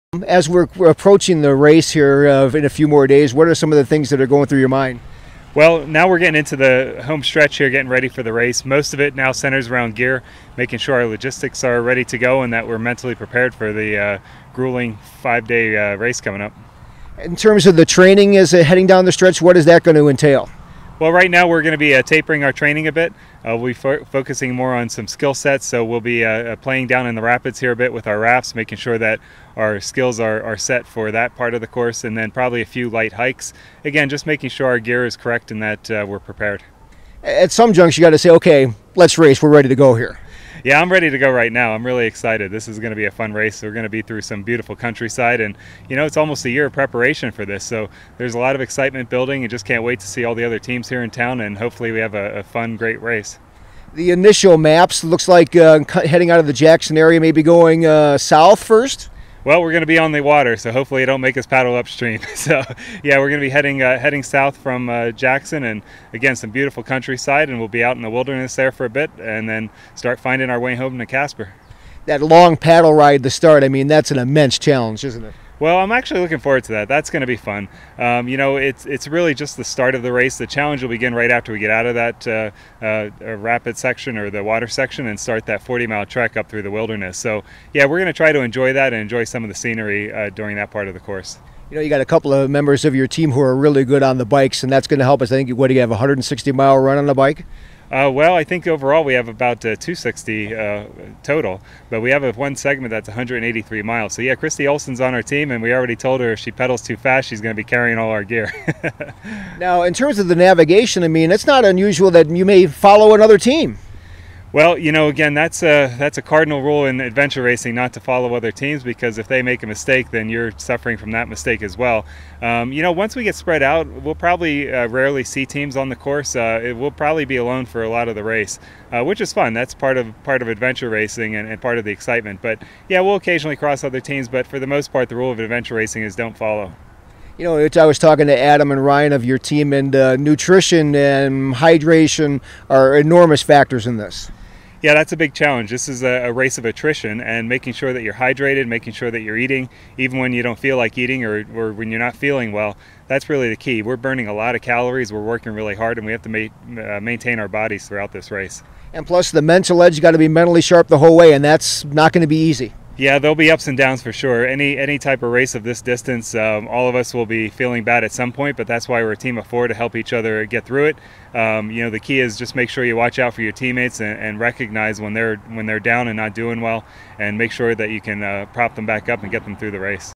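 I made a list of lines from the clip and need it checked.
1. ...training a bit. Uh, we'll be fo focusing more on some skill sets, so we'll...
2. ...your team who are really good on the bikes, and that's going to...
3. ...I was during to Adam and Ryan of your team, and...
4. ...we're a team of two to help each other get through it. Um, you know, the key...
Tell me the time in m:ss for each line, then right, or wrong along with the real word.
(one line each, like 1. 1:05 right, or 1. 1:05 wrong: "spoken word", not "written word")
1. 0:22 right
2. 1:32 right
3. 2:17 wrong: "talking", not "during"
4. 2:49 wrong: "four", not "two".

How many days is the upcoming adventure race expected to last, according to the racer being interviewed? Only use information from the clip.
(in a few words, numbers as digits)
5.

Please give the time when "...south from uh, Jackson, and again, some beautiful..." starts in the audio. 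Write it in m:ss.
1:04.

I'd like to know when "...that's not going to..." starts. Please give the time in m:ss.
2:41.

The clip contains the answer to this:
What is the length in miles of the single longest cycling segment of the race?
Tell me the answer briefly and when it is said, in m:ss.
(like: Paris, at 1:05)
183 miles, at 1:43.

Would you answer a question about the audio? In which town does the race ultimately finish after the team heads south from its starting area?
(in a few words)
Casper.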